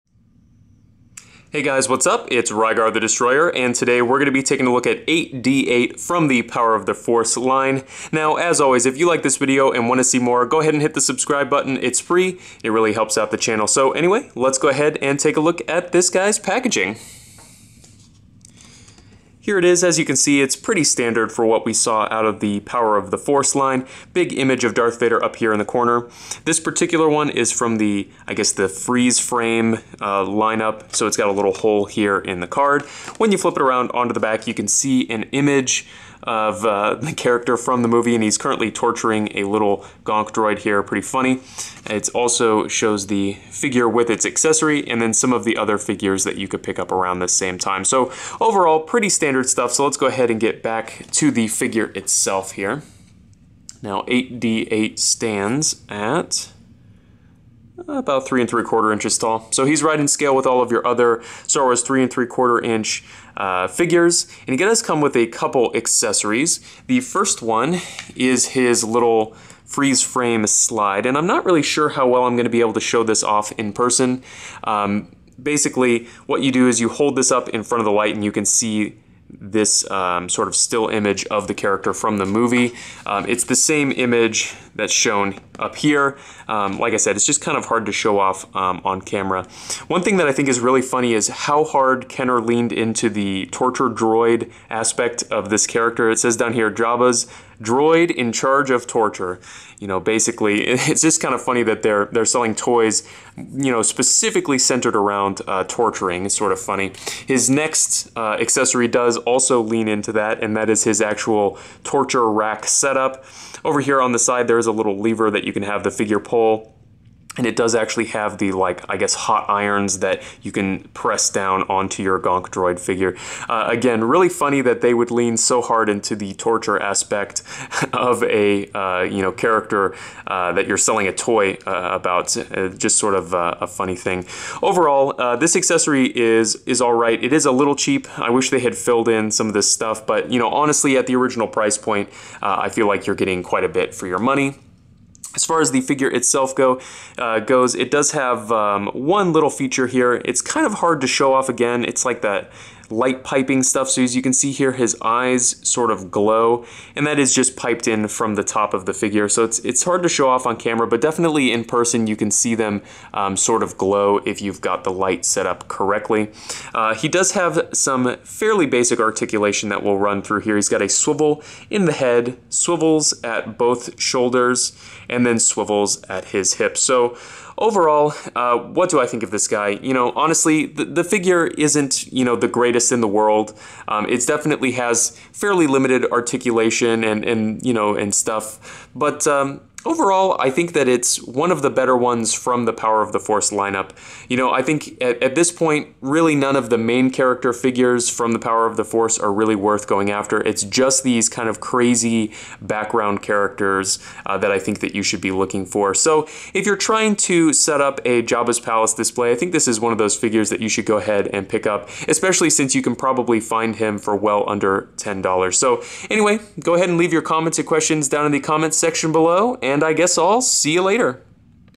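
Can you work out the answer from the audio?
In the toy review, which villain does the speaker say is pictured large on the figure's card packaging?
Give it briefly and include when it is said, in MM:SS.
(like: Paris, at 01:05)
Darth Vader, at 00:24.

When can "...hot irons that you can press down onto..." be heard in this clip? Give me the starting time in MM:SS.
01:59.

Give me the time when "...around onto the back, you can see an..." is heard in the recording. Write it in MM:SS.
00:33.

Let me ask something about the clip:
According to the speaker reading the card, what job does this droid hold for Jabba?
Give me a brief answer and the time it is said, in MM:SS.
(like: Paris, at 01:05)
in charge of torture, at 01:38.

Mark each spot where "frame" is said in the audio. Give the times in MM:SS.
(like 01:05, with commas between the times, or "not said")
00:29, 01:10.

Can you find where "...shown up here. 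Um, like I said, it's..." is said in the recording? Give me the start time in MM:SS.
01:24.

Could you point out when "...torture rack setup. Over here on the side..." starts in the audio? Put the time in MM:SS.
01:51.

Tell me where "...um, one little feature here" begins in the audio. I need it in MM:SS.
02:28.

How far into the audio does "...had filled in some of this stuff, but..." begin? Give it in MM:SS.
02:18.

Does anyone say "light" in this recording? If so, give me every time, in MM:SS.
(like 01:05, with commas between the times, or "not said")
01:17, 02:32, 02:44.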